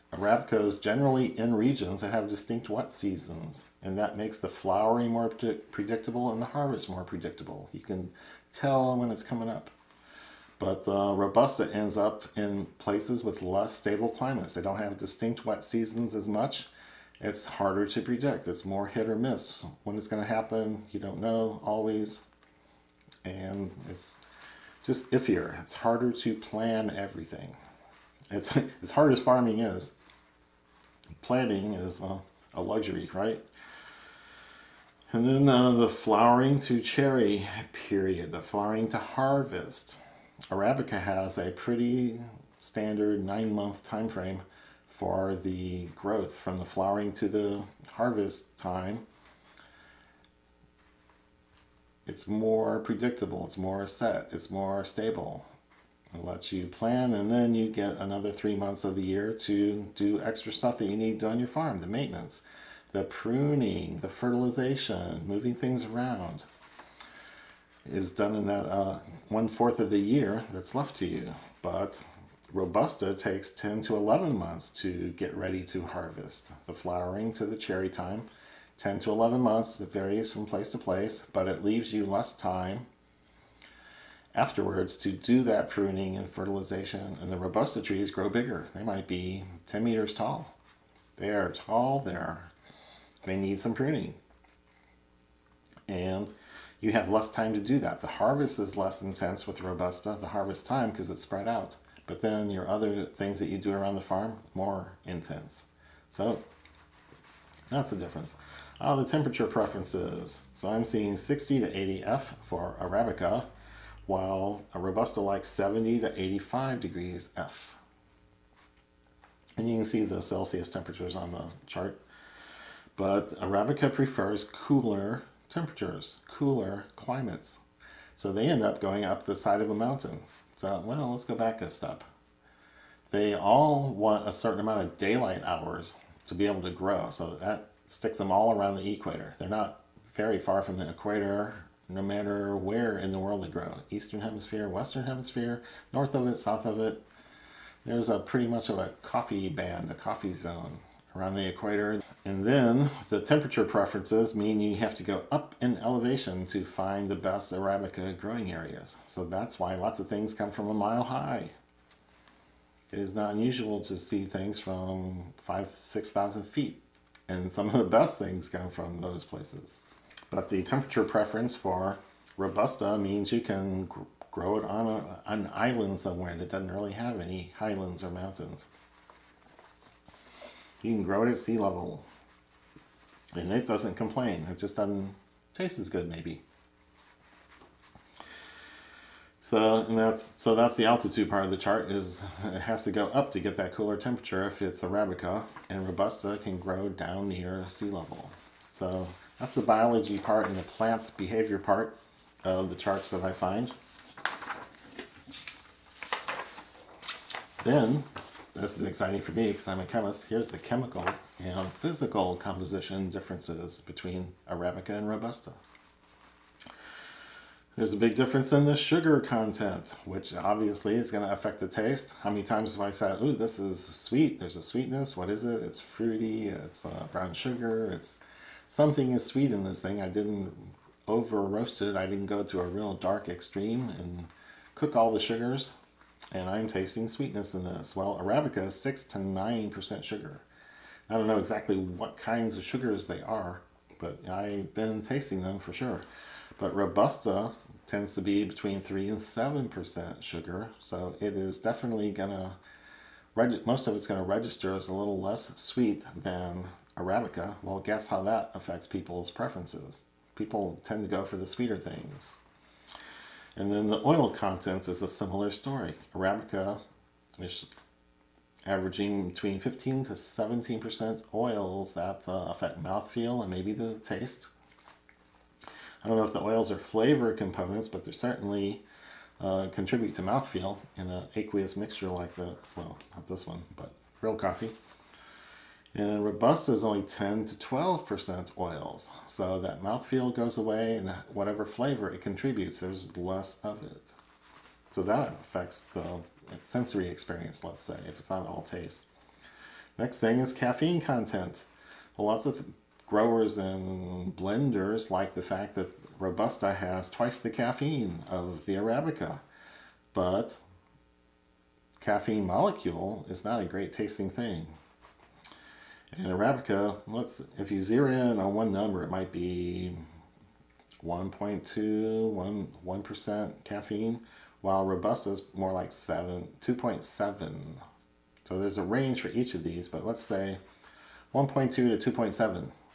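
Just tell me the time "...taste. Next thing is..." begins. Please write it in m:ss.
4:58.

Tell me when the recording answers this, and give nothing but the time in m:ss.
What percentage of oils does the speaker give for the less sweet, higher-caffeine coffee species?
4:47.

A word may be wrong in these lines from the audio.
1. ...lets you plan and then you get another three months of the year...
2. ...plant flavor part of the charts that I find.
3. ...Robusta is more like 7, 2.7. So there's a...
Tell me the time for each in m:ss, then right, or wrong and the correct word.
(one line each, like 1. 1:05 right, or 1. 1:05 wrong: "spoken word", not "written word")
1. 0:56 right
2. 3:20 wrong: "behavior", not "flavor"
3. 5:24 right.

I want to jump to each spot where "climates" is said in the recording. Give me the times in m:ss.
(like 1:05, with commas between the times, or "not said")
0:14, 2:06.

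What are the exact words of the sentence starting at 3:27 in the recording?
Then this is exciting for me because I'm a chemist.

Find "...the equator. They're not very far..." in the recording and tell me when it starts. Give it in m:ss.
2:18.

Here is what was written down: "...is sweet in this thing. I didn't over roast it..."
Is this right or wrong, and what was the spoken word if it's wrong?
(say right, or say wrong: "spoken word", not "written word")
right.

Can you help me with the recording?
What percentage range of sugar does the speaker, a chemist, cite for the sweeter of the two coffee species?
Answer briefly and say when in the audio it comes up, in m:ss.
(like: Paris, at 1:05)
6 to 9%, at 3:58.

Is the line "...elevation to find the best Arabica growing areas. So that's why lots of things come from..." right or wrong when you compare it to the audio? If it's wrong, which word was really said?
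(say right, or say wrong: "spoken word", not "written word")
right.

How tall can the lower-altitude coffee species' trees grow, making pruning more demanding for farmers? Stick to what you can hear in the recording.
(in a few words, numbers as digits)
10 meters.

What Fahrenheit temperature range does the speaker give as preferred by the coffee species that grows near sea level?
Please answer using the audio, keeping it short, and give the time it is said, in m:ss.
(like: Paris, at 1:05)
70 to 85 degrees F, at 1:55.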